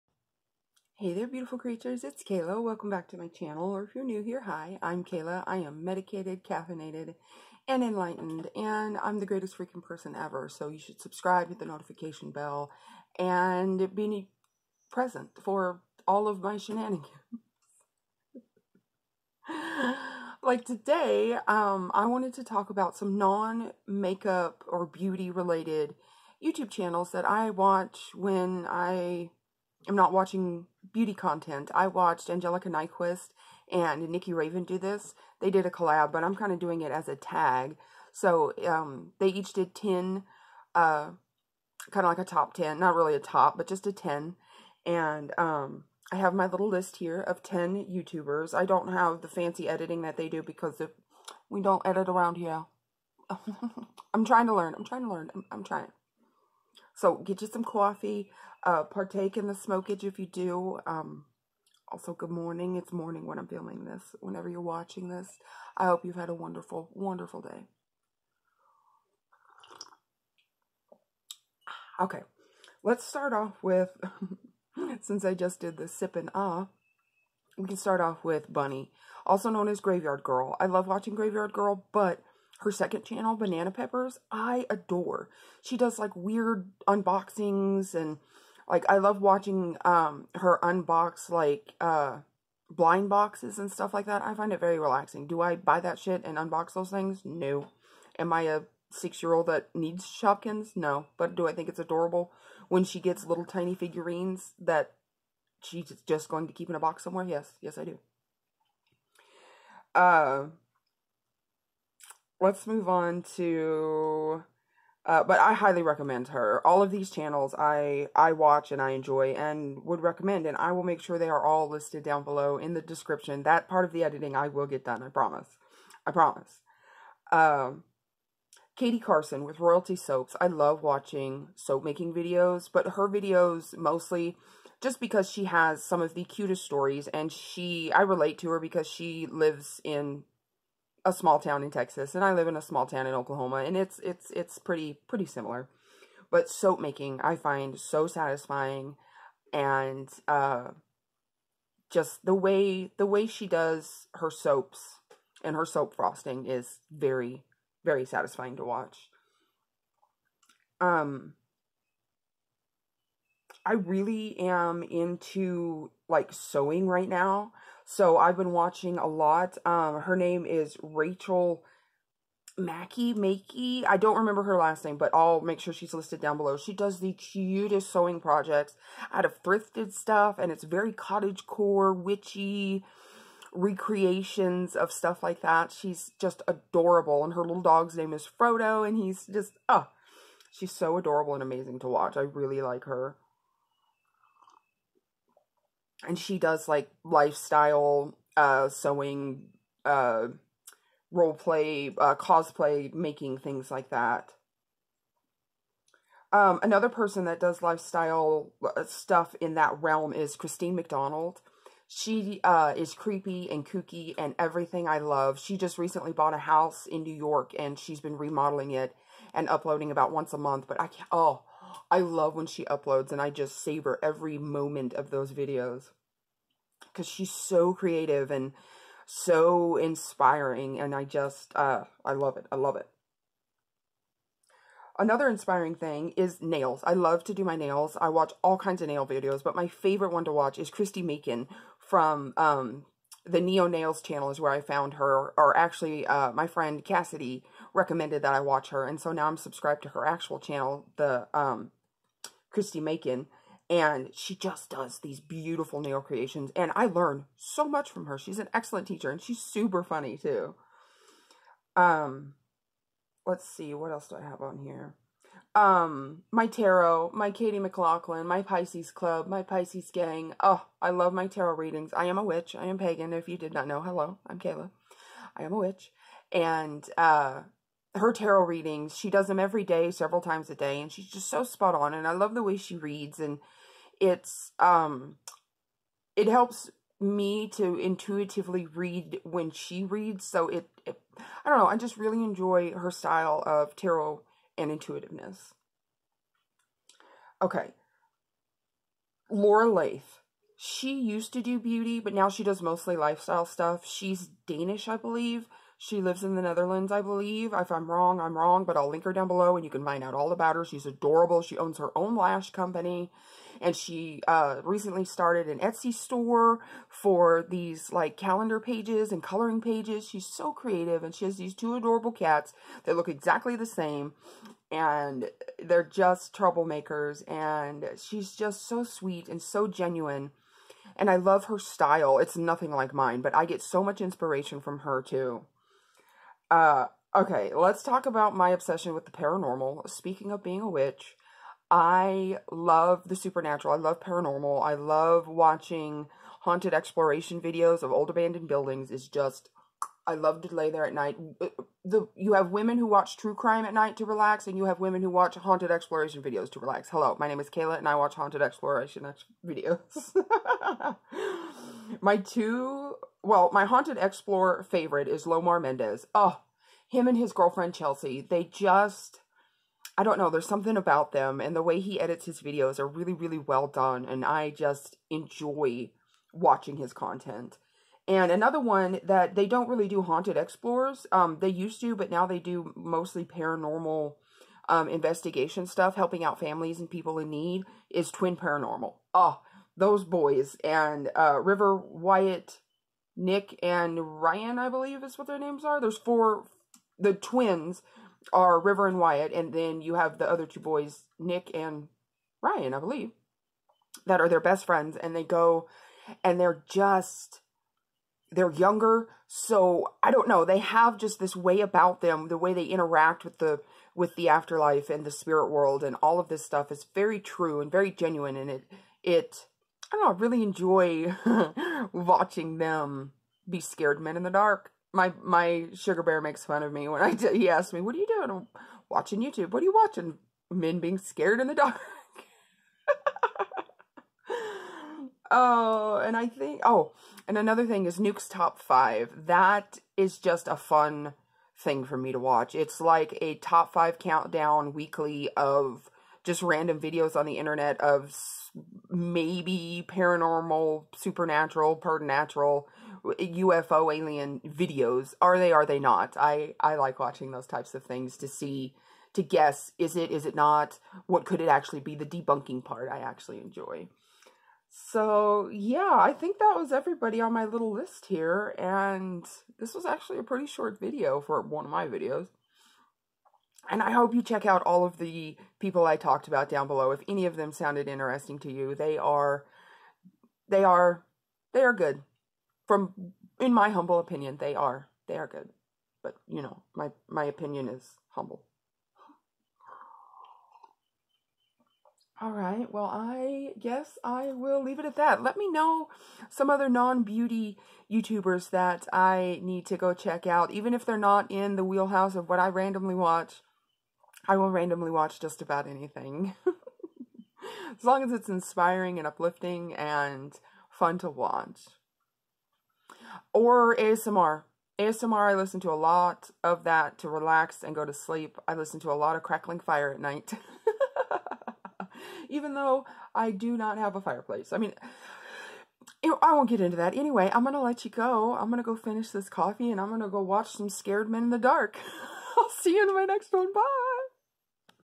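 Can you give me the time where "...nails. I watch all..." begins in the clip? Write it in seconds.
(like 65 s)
237 s.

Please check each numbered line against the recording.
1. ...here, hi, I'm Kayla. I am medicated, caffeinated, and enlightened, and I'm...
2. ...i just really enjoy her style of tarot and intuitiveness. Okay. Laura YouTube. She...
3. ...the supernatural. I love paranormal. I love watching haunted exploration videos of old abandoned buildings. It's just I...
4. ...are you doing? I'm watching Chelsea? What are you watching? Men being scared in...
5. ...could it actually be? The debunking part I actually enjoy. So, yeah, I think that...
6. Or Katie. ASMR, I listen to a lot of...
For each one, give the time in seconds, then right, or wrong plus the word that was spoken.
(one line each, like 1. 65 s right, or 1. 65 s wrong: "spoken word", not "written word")
1. 4 s right
2. 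291 s wrong: "Leth", not "YouTube"
3. 343 s right
4. 427 s wrong: "YouTube", not "Chelsea"
5. 461 s right
6. 513 s wrong: "ASMR", not "Katie".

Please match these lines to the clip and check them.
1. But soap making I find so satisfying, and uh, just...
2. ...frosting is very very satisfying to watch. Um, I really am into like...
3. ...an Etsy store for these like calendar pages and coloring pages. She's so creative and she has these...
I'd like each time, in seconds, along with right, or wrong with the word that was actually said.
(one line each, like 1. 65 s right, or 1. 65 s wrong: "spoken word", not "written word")
1. 146 s right
2. 155 s right
3. 315 s right.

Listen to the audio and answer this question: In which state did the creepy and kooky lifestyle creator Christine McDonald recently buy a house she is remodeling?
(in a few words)
New York.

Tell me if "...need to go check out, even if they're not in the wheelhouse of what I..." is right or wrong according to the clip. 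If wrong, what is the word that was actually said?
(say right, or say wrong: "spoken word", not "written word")
right.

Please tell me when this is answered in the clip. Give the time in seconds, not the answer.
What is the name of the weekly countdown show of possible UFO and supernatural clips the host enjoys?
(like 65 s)
437 s.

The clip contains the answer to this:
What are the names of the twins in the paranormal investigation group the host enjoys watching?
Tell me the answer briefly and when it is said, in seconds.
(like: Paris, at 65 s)
River and Wyatt, at 398 s.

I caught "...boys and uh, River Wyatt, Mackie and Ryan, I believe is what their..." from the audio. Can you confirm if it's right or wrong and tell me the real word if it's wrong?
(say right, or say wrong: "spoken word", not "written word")
wrong: "Nick", not "Mackie".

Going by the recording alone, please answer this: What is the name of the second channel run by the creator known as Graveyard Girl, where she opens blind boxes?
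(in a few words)
Banana Peppers.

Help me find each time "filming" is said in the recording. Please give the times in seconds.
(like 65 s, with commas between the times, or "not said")
63 s.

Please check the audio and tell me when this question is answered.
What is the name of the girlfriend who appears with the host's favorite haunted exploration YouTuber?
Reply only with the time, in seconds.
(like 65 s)
367 s.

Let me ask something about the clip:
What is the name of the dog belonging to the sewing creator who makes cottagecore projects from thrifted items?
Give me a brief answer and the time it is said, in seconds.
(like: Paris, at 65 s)
Frodo, at 188 s.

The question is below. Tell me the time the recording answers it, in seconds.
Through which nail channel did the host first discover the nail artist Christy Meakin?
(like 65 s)
243 s.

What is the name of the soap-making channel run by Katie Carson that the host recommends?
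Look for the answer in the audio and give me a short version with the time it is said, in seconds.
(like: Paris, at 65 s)
Royalty Soaps, at 129 s.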